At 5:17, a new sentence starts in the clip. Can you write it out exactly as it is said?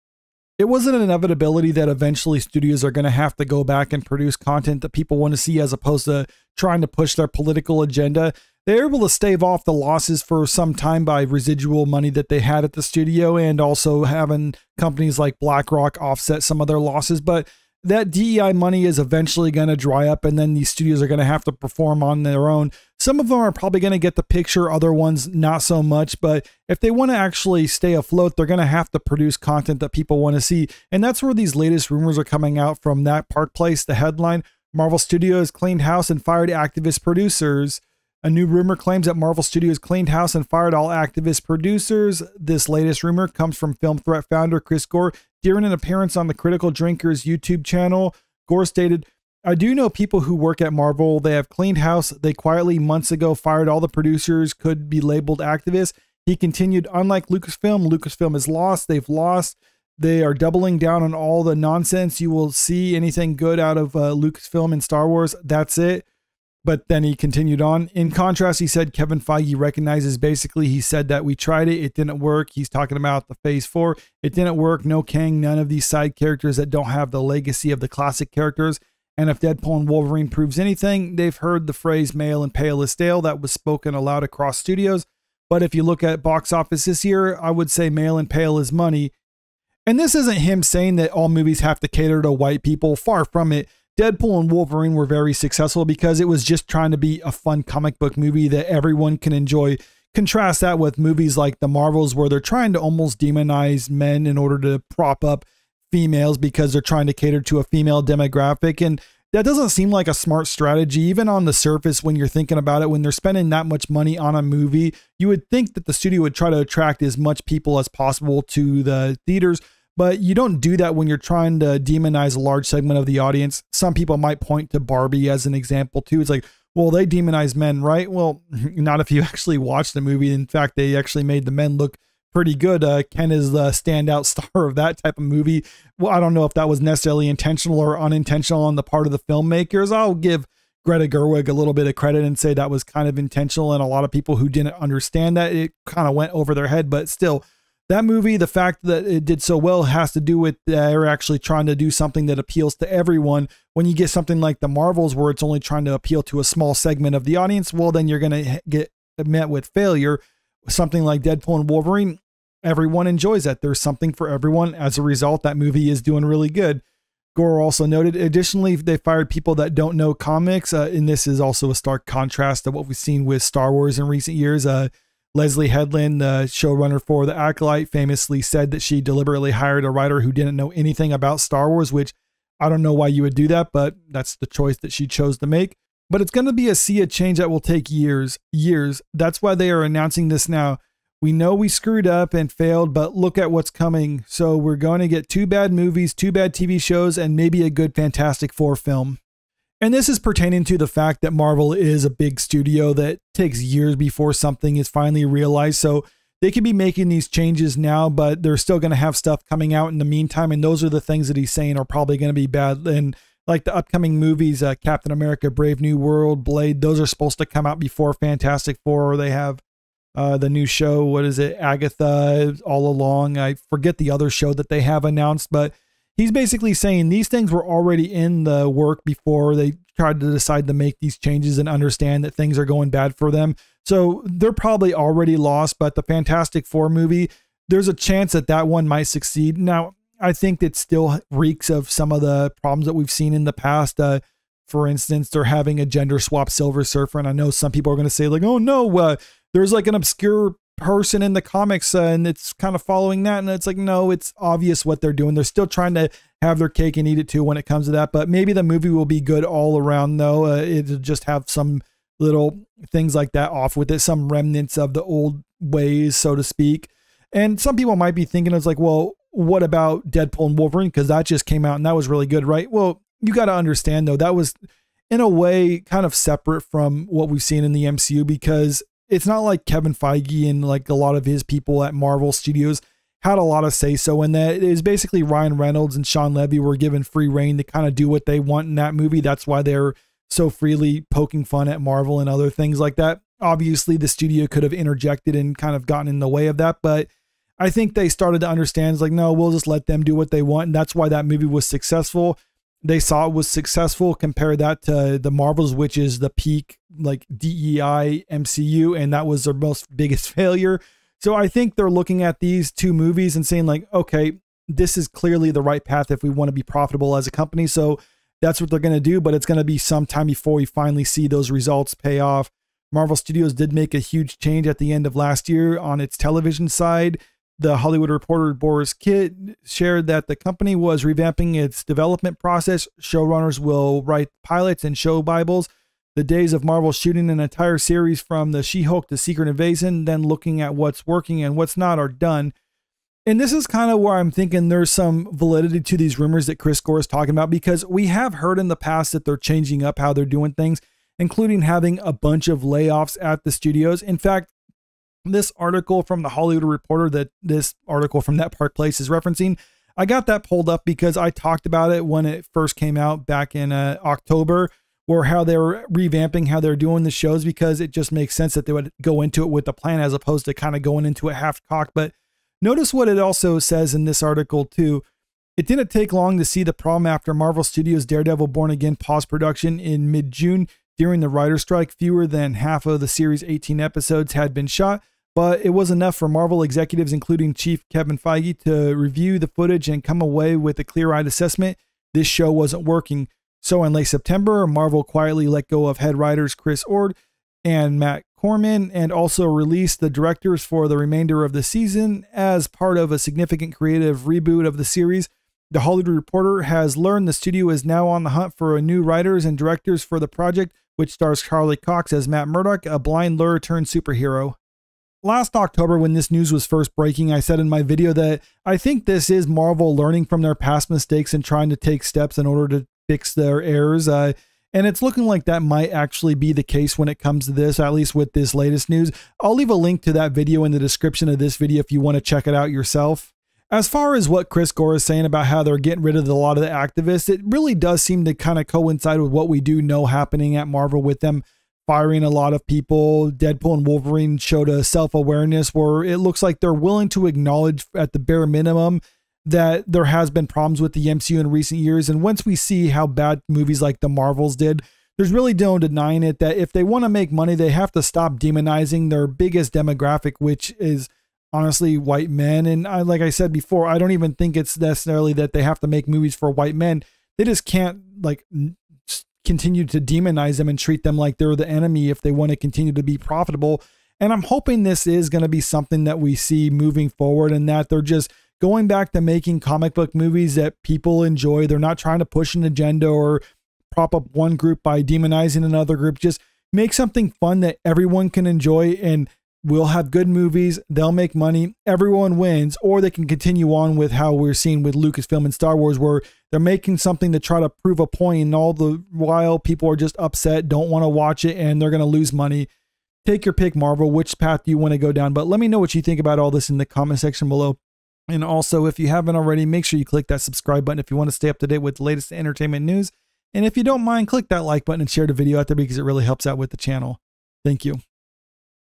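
So that's what they're going to do, but it's going to be some time before we finally see those results pay off.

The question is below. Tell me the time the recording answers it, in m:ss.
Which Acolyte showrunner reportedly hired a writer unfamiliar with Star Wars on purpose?
2:55.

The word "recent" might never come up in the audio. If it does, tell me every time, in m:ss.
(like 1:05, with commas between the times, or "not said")
2:54, 7:31.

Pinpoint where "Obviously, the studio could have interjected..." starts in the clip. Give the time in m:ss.
4:53.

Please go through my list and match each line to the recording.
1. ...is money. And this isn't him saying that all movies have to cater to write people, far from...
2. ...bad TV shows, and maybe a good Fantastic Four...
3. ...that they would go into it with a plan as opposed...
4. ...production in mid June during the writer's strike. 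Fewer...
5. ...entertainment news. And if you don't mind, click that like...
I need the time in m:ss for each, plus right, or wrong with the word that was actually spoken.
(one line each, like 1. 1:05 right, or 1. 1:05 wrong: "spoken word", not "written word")
1. 1:28 wrong: "white", not "write"
2. 3:16 right
3. 6:08 right
4. 6:19 right
5. 8:32 right.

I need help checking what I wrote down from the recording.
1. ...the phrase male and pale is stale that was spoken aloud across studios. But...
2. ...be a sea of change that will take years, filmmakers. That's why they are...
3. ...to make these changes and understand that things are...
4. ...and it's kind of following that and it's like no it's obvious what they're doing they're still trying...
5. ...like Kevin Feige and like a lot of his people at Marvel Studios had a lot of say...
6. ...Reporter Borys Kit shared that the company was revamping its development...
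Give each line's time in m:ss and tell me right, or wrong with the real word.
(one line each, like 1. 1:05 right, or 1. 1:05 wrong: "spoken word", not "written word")
1. 1:21 right
2. 3:06 wrong: "years", not "filmmakers"
3. 3:50 right
4. 4:12 right
5. 4:39 right
6. 5:28 right.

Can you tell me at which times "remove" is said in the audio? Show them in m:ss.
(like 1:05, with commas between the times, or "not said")
not said.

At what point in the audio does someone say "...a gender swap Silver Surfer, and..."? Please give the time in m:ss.
4:05.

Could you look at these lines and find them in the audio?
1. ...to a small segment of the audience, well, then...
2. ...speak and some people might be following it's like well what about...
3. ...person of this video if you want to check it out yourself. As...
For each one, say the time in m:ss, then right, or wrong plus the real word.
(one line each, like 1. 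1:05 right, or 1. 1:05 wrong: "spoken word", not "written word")
1. 2:36 right
2. 4:26 wrong: "thinking", not "following"
3. 7:10 wrong: "description", not "person".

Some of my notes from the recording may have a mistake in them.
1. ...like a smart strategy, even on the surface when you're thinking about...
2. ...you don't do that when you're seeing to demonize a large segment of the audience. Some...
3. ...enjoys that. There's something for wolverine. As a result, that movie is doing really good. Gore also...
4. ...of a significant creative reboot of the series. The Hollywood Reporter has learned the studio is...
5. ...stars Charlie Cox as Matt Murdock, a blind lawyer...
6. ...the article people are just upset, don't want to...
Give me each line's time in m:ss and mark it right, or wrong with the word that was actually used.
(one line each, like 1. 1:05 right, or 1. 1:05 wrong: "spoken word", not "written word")
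1. 1:49 right
2. 2:00 wrong: "trying", not "seeing"
3. 2:43 wrong: "everyone", not "wolverine"
4. 6:42 right
5. 6:51 right
6. 8:18 wrong: "while", not "article".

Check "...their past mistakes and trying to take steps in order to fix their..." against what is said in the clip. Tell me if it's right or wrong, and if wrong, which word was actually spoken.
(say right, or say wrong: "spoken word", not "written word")
right.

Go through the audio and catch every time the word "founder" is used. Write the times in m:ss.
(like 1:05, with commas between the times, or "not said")
0:44.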